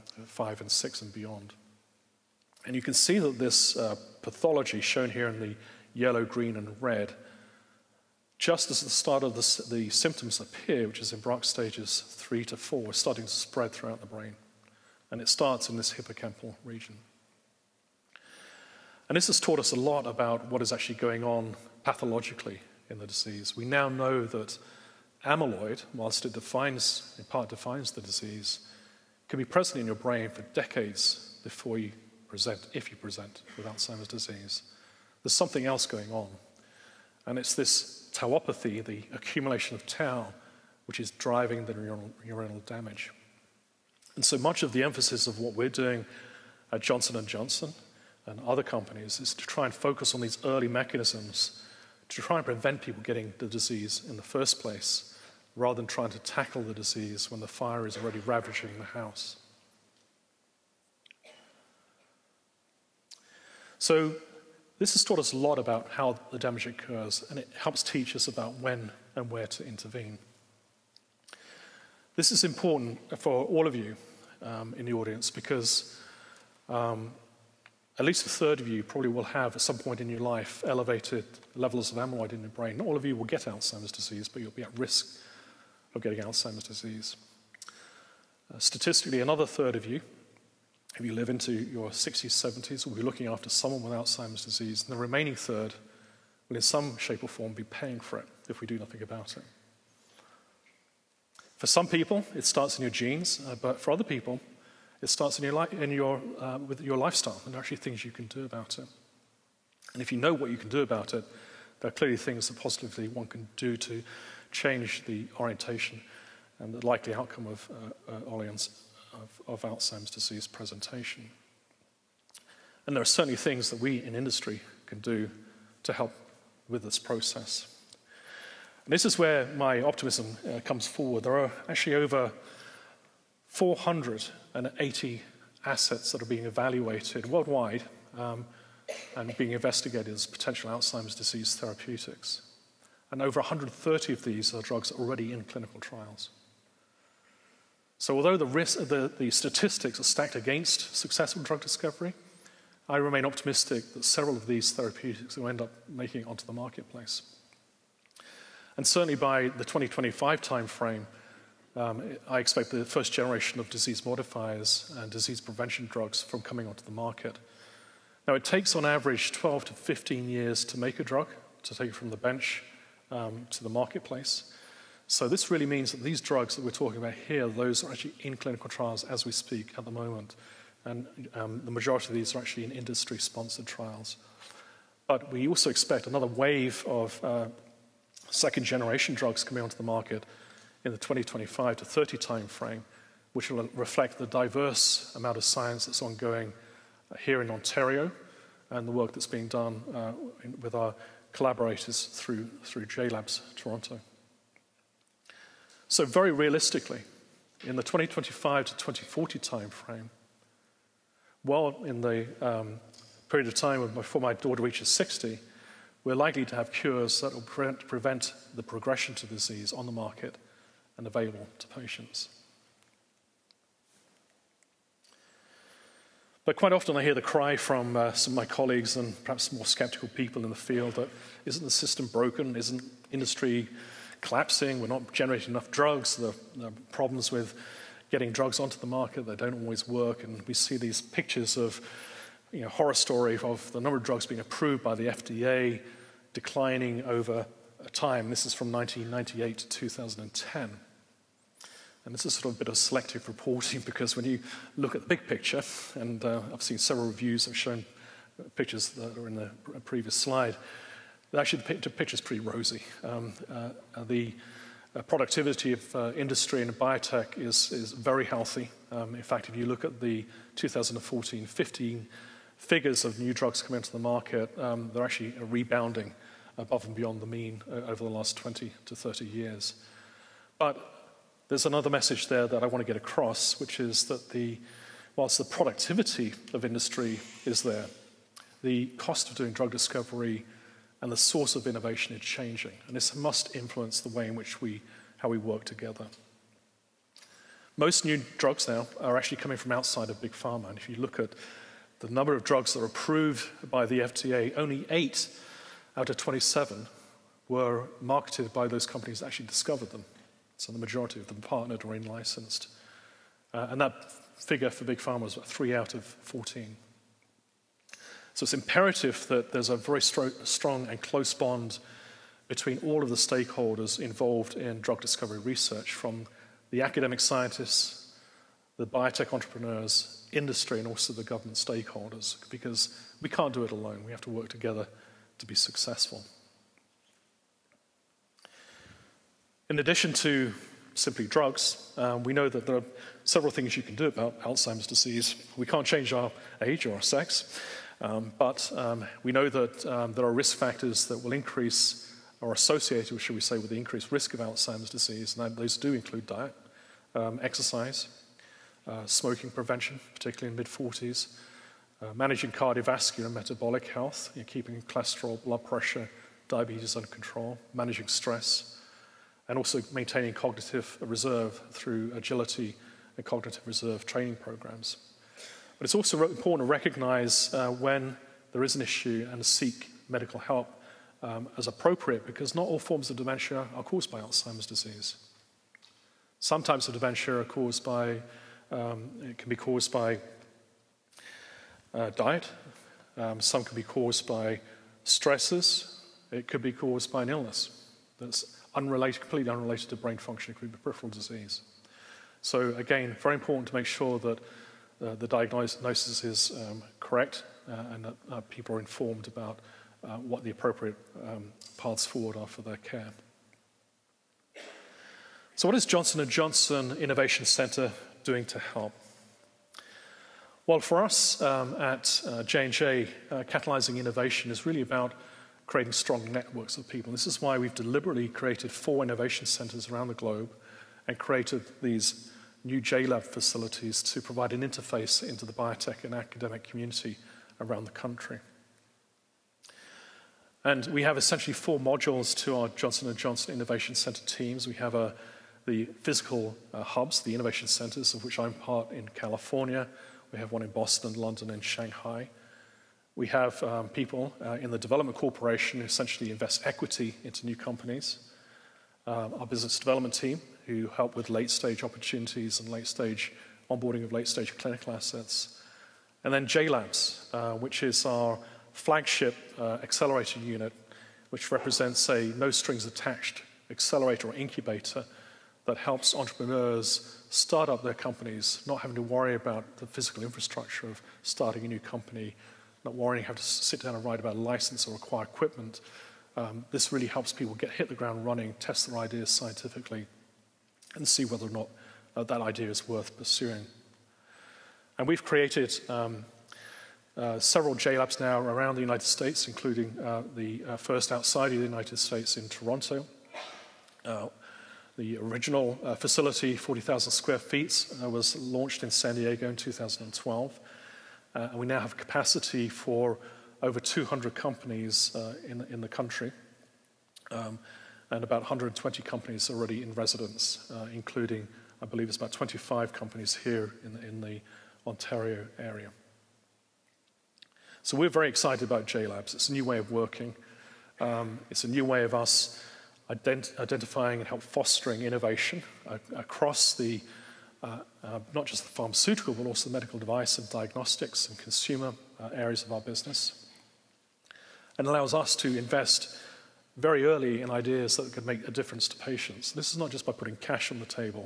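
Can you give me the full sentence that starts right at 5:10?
So the majority of them partnered or in licensed.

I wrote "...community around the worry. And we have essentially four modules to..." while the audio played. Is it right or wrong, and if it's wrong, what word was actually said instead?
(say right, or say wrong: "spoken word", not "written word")
wrong: "country", not "worry".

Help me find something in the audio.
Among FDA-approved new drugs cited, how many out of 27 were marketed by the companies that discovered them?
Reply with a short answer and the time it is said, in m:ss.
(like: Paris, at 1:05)
8, at 5:04.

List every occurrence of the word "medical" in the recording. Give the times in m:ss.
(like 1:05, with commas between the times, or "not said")
6:20, 8:59.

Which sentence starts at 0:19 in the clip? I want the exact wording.
And this has taught us a lot about what is actually going on pathologically in the disease.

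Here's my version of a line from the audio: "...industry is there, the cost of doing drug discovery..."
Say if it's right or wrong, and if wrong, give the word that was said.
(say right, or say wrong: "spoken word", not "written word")
right.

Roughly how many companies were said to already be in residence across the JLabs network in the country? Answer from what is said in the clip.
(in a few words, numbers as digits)
About 120.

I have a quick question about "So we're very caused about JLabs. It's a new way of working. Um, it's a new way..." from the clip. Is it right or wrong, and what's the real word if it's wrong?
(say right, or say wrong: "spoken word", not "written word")
wrong: "excited", not "caused".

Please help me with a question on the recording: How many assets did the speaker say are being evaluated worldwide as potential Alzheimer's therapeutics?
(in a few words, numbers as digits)
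Over 480.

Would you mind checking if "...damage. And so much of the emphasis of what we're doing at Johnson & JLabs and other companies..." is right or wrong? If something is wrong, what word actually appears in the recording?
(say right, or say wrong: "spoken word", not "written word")
wrong: "Johnson", not "JLabs".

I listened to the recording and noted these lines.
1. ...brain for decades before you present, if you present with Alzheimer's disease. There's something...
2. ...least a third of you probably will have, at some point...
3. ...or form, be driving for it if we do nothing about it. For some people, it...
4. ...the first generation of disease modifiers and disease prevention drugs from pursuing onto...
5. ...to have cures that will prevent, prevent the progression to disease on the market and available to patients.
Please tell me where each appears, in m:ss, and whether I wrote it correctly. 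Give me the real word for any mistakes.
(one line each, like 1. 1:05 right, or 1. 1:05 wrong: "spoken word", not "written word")
1. 0:29 right
2. 1:18 right
3. 1:37 wrong: "paying", not "driving"
4. 2:42 wrong: "coming", not "pursuing"
5. 3:36 right.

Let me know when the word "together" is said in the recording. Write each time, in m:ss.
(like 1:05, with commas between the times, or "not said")
4:55, 5:34.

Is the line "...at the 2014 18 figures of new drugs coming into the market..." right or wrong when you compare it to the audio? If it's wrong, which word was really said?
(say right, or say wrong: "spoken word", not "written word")
wrong: "15", not "18".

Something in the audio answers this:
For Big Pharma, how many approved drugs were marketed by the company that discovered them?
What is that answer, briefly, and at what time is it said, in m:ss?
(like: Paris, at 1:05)
3 out of 14, at 5:15.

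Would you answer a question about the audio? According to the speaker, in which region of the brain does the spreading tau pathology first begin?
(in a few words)
Hippocampal region.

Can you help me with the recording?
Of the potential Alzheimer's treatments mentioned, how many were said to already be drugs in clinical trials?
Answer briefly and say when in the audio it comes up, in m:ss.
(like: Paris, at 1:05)
Over 130, at 2:23.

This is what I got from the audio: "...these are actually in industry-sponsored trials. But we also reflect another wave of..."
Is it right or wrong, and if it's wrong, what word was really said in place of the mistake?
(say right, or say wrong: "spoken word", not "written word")
wrong: "expect", not "reflect".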